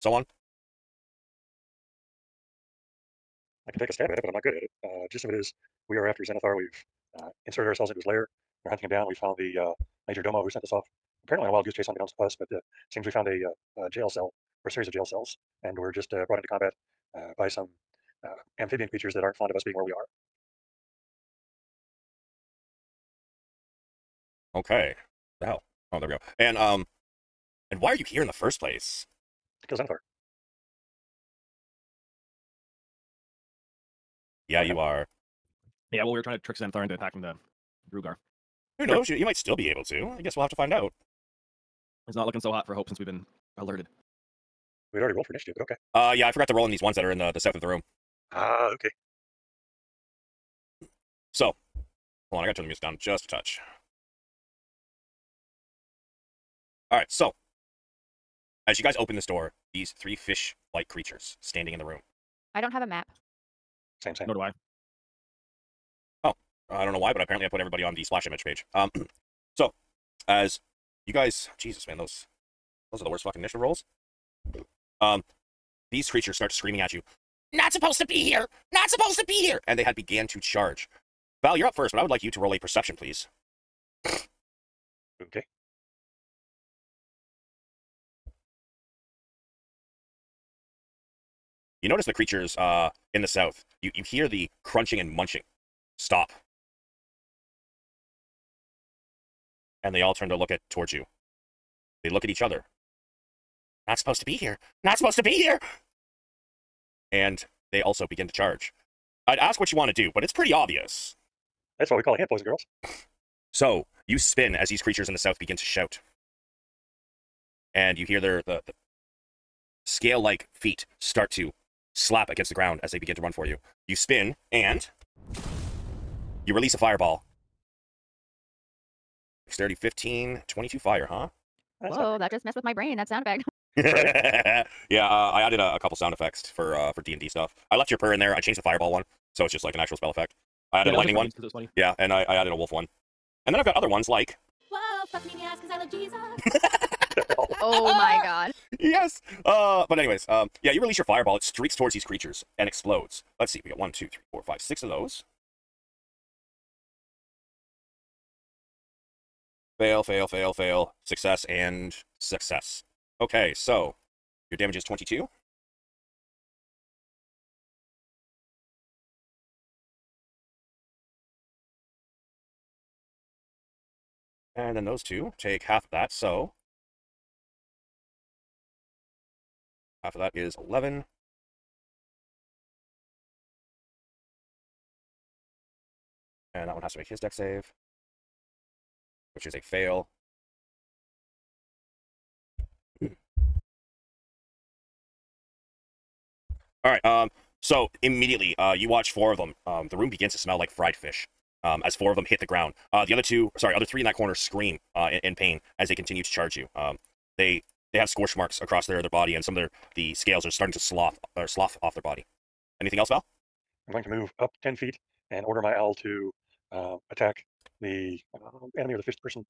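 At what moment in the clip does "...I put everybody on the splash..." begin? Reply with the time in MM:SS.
01:07.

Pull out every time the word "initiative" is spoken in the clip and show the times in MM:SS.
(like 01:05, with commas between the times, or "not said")
00:45, 01:13.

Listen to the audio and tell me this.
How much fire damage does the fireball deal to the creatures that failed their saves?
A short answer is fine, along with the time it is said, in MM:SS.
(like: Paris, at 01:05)
22, at 02:10.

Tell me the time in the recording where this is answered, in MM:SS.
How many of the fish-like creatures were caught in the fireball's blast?
02:34.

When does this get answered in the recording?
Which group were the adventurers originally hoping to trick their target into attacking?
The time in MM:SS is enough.
00:36.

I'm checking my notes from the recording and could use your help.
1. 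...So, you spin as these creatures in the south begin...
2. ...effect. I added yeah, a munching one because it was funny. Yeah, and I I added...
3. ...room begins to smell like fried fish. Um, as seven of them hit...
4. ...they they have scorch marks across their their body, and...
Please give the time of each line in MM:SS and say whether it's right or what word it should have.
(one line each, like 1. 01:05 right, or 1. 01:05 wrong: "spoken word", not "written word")
1. 01:53 right
2. 02:20 wrong: "lightning", not "munching"
3. 03:19 wrong: "four", not "seven"
4. 03:27 right.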